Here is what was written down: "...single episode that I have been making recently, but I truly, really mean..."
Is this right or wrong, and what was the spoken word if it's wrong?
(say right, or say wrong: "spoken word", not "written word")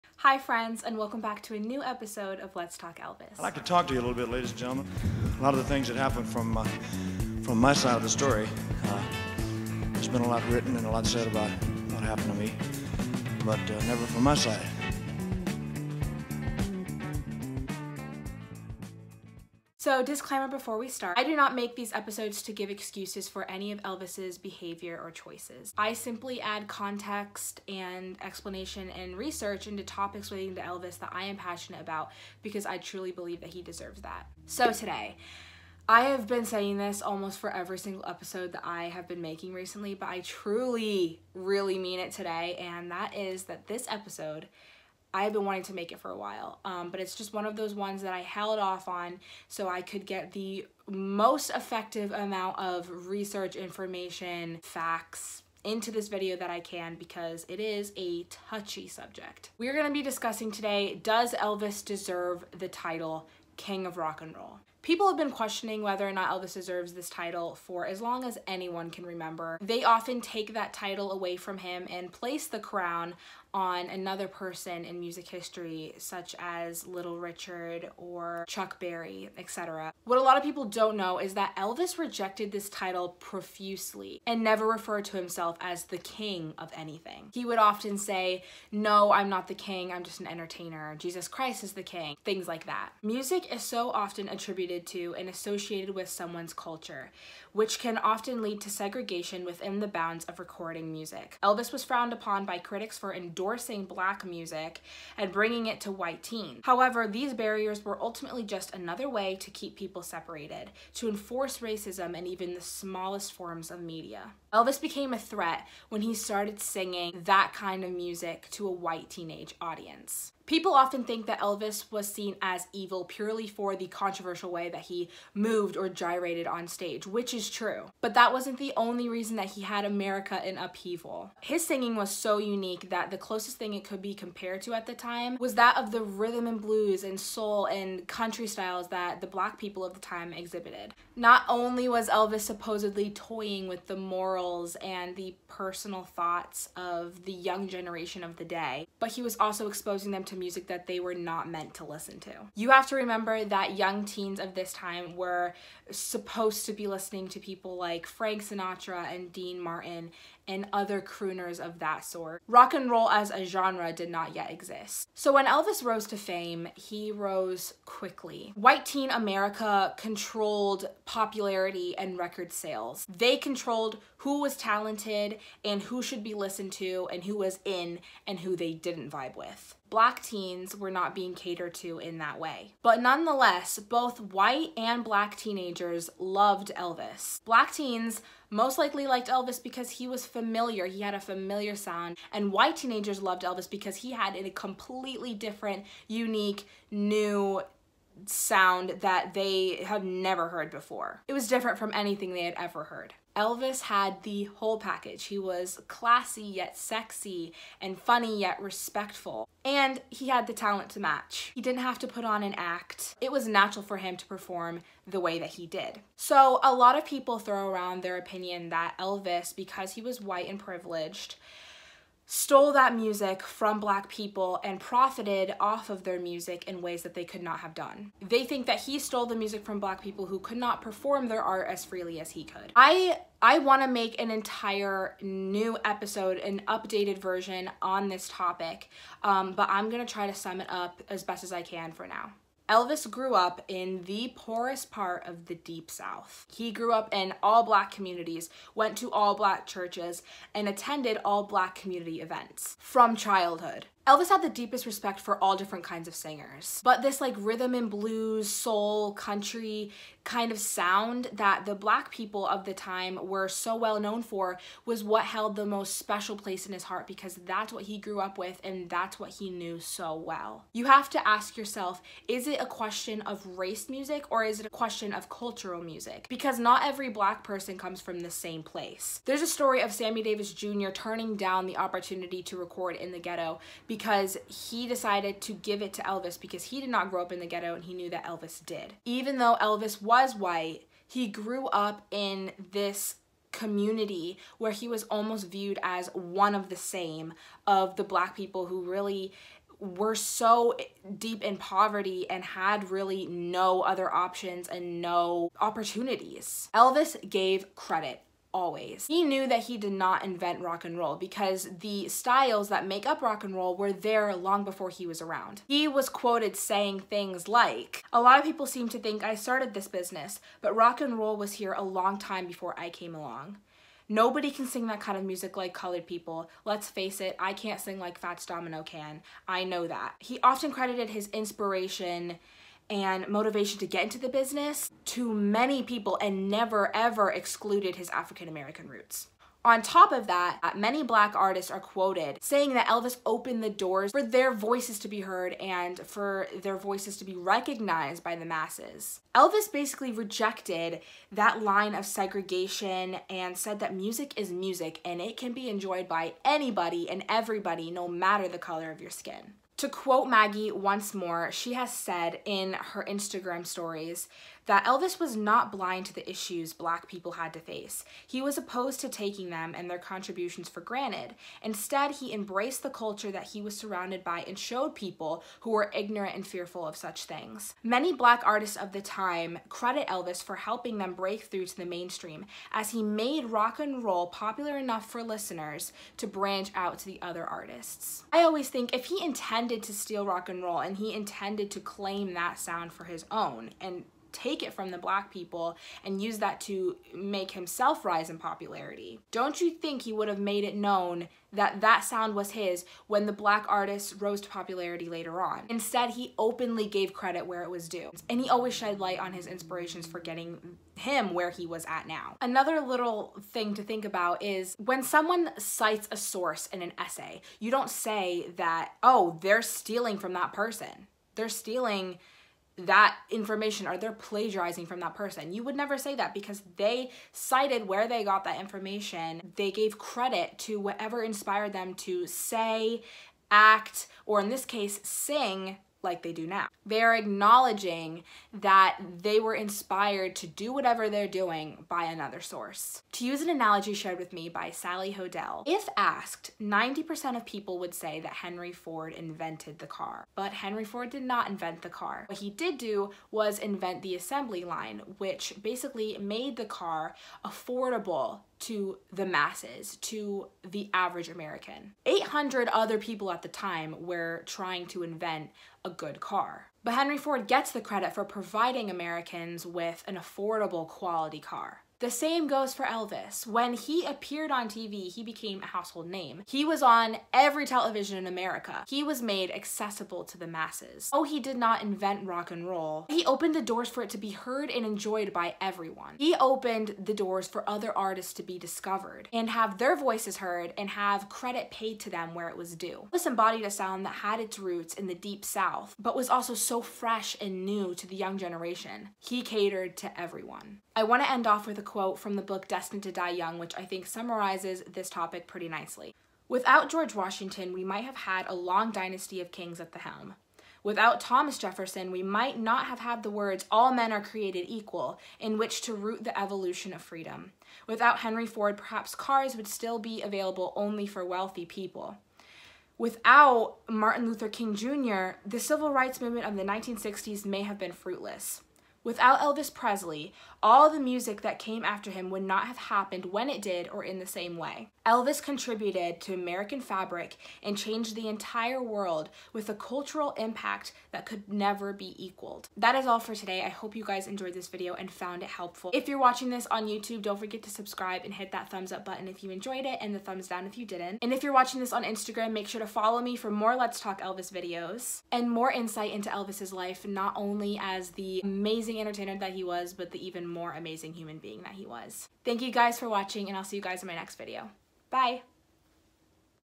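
right.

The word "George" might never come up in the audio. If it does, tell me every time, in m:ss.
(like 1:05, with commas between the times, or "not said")
8:26.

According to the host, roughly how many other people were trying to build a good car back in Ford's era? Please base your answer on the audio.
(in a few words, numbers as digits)
800.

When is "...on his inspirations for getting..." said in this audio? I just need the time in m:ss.
6:49.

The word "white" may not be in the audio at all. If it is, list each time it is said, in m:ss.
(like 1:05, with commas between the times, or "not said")
1:45, 1:58, 2:48, 3:04, 3:12, 3:40, 4:50.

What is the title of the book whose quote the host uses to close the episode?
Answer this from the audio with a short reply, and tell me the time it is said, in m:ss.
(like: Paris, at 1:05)
Destined to Die Young, at 8:22.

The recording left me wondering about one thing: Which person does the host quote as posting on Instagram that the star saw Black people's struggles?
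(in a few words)
Maggie.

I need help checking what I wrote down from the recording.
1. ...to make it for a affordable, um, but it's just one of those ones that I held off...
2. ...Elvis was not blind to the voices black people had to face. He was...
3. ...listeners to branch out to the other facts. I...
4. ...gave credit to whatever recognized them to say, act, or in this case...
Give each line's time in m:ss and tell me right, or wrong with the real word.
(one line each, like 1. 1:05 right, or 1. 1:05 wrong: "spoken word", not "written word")
1. 0:45 wrong: "while", not "affordable"
2. 6:04 wrong: "issues", not "voices"
3. 6:25 wrong: "artists", not "facts"
4. 7:09 wrong: "inspired", not "recognized".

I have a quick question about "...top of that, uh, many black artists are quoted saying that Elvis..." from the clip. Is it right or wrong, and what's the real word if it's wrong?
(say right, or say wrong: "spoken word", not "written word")
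right.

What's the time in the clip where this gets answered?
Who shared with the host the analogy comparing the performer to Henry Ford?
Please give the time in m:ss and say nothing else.
7:24.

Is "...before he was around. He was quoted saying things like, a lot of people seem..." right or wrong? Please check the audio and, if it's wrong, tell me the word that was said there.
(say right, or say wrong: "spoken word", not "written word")
right.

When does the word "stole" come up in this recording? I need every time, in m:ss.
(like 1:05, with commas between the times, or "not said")
3:42, 3:48.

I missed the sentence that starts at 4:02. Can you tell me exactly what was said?
Elvis grew up in the poorest part of the Deep South.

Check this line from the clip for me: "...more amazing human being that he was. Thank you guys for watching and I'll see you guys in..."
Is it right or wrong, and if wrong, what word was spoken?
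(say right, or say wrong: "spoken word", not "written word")
right.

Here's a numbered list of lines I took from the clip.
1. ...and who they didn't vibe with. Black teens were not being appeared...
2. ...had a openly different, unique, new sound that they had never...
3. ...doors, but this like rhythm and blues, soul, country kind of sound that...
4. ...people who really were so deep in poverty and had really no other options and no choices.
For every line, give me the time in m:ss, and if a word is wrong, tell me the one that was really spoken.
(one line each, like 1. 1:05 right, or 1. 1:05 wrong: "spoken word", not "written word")
1. 2:58 wrong: "catered", not "appeared"
2. 3:14 wrong: "completely", not "openly"
3. 4:16 wrong: "singers", not "doors"
4. 4:58 wrong: "opportunities", not "choices".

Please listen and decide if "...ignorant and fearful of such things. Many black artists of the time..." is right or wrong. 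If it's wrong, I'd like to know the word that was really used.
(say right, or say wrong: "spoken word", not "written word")
right.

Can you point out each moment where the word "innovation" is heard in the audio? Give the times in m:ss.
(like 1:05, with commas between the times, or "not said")
not said.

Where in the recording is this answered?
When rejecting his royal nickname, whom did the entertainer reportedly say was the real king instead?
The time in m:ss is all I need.
1:30.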